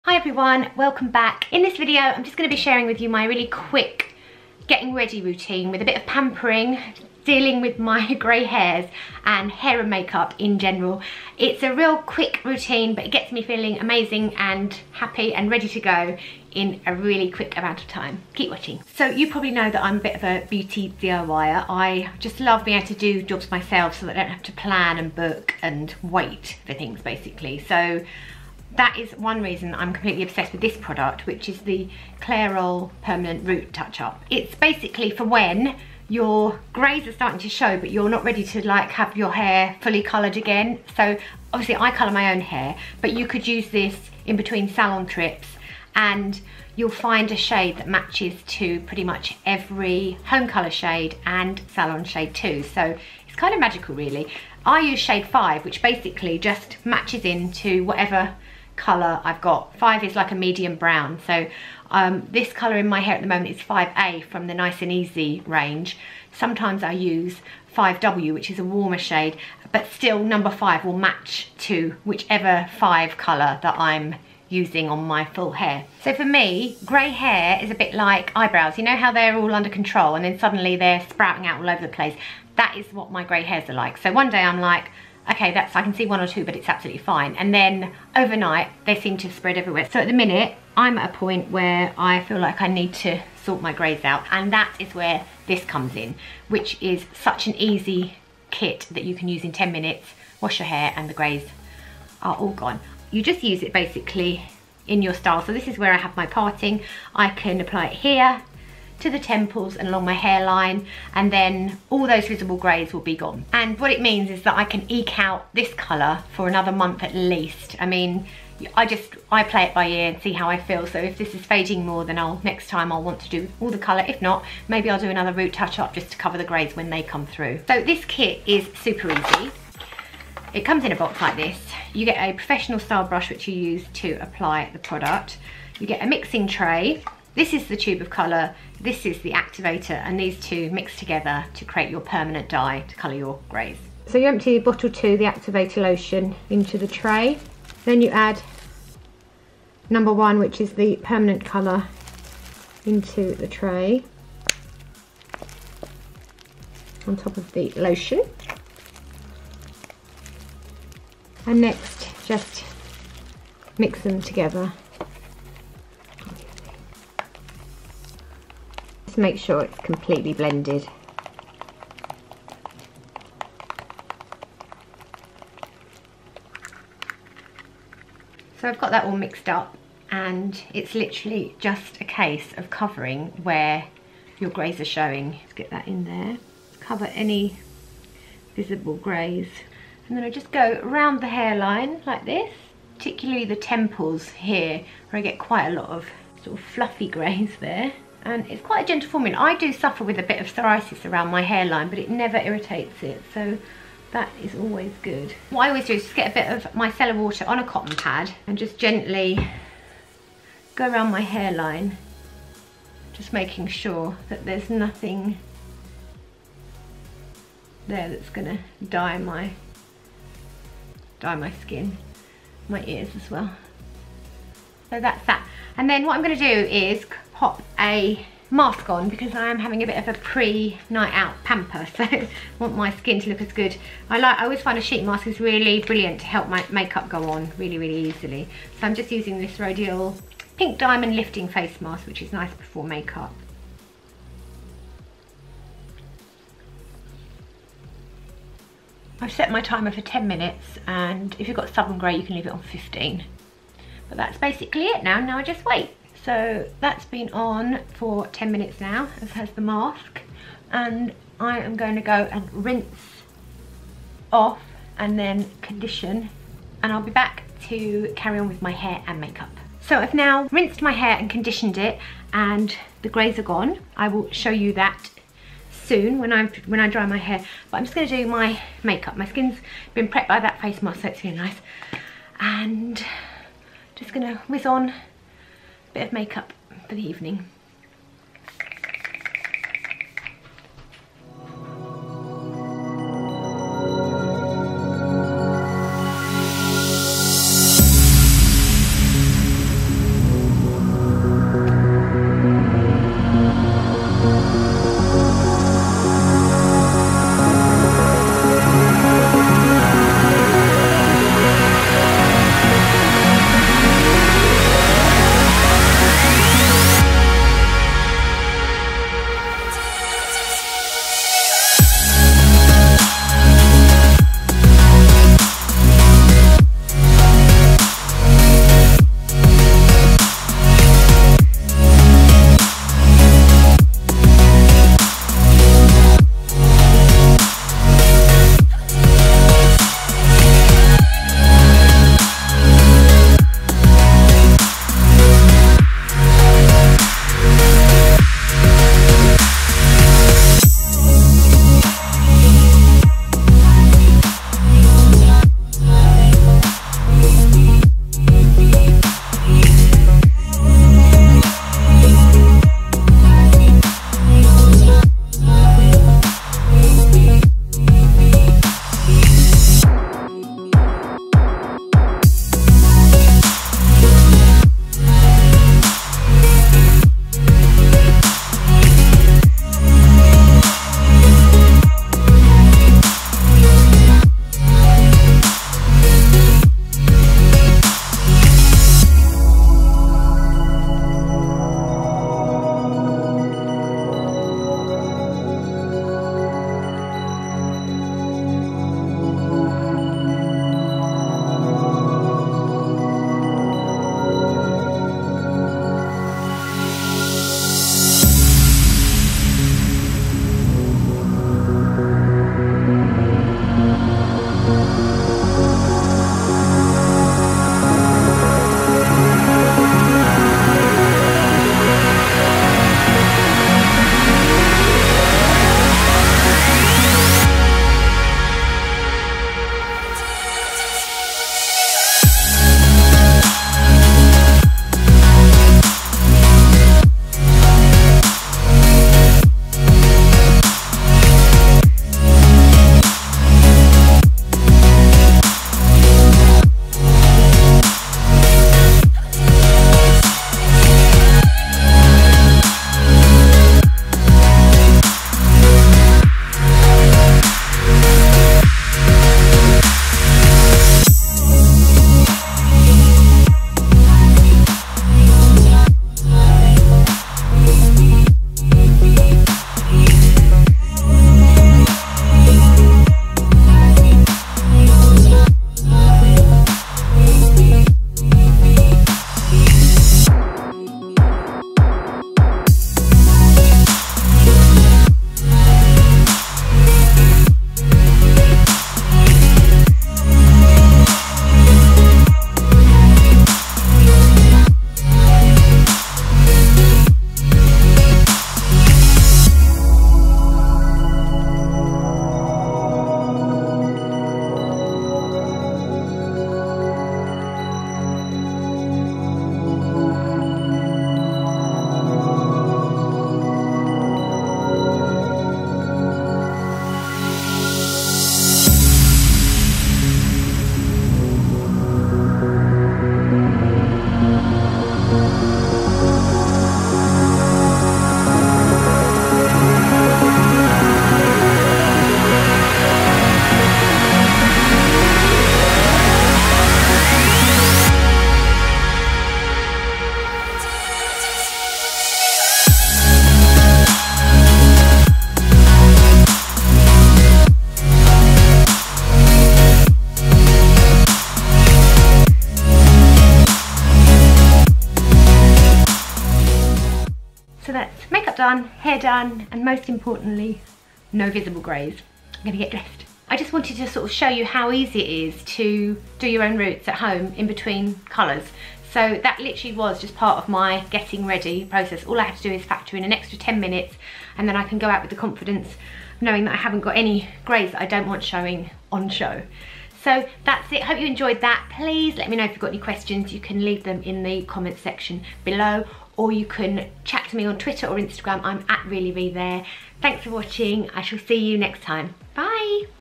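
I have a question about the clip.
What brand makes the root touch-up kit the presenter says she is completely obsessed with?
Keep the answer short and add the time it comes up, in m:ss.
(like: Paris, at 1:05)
Clairol, at 0:32.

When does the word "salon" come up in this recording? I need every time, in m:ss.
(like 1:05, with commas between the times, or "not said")
0:44, 0:51.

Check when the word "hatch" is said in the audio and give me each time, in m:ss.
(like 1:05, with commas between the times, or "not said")
not said.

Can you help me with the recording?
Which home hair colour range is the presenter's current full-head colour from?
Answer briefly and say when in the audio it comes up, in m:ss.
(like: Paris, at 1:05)
Nice and Easy, at 1:04.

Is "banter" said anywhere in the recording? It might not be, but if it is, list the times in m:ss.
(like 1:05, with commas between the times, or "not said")
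not said.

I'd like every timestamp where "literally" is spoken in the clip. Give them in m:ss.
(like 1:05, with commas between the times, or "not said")
3:00, 9:29.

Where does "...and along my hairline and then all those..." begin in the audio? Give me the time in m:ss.
1:49.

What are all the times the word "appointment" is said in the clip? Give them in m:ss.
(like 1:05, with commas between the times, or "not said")
not said.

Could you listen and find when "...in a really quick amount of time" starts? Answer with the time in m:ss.
0:16.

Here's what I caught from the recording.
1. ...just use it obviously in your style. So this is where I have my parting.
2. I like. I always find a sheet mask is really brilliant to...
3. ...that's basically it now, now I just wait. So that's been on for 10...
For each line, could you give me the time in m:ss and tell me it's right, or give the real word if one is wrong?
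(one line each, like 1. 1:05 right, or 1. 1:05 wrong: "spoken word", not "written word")
1. 1:43 wrong: "basically", not "obviously"
2. 3:54 right
3. 4:14 right.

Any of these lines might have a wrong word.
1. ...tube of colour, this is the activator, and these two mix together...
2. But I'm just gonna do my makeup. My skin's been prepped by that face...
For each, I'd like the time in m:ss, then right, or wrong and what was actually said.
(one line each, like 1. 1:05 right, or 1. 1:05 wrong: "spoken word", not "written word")
1. 2:17 right
2. 4:37 right.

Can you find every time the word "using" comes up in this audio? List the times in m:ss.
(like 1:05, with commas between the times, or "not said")
1:14, 3:59.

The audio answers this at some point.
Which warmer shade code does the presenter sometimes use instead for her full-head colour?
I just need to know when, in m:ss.
1:07.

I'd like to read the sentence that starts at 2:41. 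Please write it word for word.
And next, just mix them together Just make sure it's completely blended.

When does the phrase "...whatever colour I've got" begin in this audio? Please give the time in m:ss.
0:57.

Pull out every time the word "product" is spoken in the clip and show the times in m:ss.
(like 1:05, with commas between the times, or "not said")
0:30, 2:14.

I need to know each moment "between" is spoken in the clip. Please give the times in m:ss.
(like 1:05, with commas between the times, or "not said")
0:44, 9:27.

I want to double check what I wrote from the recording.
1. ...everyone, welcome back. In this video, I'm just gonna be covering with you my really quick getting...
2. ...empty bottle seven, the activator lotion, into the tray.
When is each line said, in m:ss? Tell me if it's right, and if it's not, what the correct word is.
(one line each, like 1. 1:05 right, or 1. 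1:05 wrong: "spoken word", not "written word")
1. 0:00 wrong: "sharing", not "covering"
2. 2:24 wrong: "two", not "seven".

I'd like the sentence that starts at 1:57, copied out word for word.
I mean, I just, I play it by ear and see how I feel.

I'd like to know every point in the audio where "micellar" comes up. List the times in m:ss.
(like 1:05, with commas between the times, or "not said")
3:26.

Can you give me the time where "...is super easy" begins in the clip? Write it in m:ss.
2:08.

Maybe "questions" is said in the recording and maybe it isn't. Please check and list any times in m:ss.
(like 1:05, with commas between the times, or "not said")
9:42.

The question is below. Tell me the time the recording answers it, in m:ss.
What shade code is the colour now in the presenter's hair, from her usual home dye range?
1:03.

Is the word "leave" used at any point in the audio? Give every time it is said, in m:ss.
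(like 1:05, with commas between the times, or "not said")
4:12, 9:43.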